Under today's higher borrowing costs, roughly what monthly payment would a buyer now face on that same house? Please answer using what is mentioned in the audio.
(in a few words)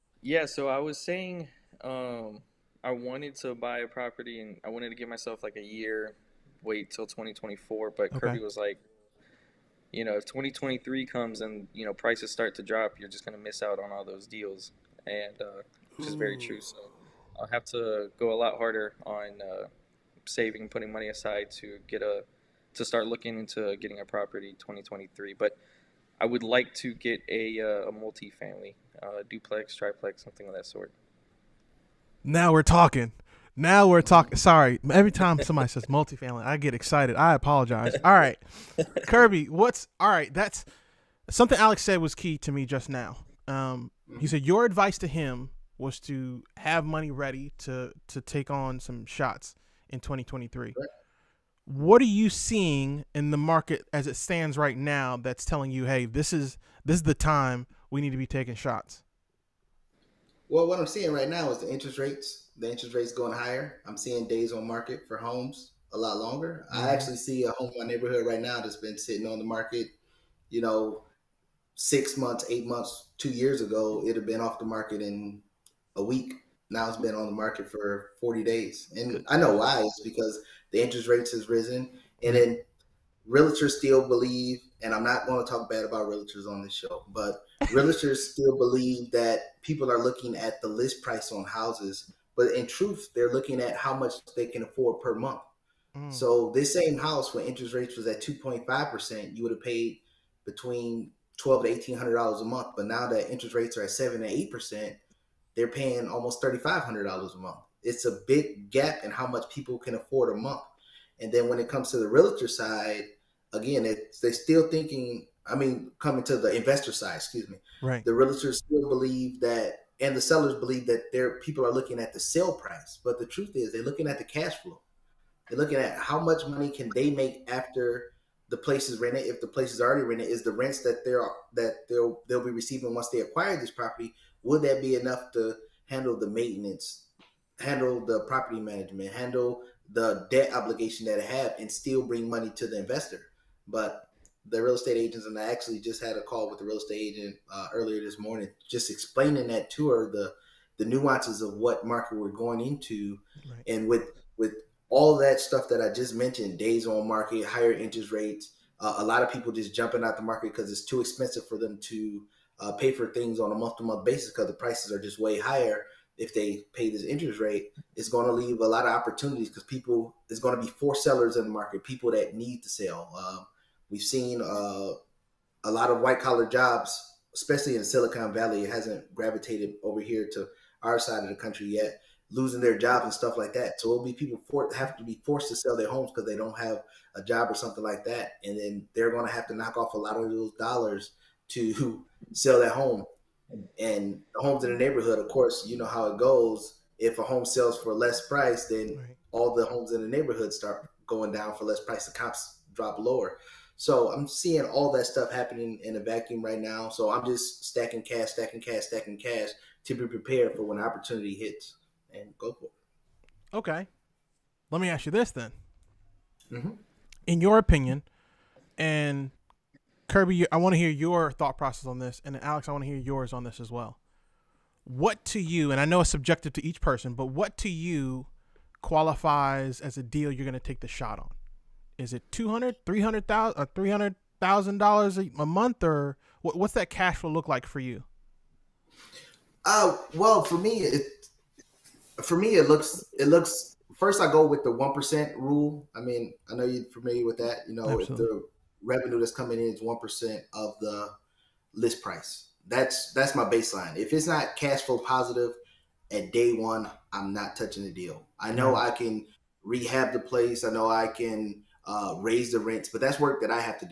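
$3,500.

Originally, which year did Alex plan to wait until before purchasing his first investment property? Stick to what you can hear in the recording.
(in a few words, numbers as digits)
2024.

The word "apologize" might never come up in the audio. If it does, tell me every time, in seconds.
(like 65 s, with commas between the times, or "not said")
37 s.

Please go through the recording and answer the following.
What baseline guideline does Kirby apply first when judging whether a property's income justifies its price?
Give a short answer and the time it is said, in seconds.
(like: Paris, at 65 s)
one percent rule, at 244 s.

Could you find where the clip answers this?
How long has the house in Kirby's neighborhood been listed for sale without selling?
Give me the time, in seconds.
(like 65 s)
78 s.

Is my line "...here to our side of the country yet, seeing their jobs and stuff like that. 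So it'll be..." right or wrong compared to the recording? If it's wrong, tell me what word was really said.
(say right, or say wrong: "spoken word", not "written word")
wrong: "losing", not "seeing".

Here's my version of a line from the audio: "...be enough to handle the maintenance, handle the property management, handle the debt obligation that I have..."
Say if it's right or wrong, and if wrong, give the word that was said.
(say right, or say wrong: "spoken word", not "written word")
right.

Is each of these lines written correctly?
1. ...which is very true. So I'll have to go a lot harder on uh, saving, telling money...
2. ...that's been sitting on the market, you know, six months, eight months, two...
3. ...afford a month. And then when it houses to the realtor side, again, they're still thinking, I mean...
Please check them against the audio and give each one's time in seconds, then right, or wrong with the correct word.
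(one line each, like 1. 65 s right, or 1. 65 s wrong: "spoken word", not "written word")
1. 15 s wrong: "putting", not "telling"
2. 68 s right
3. 109 s wrong: "comes", not "houses".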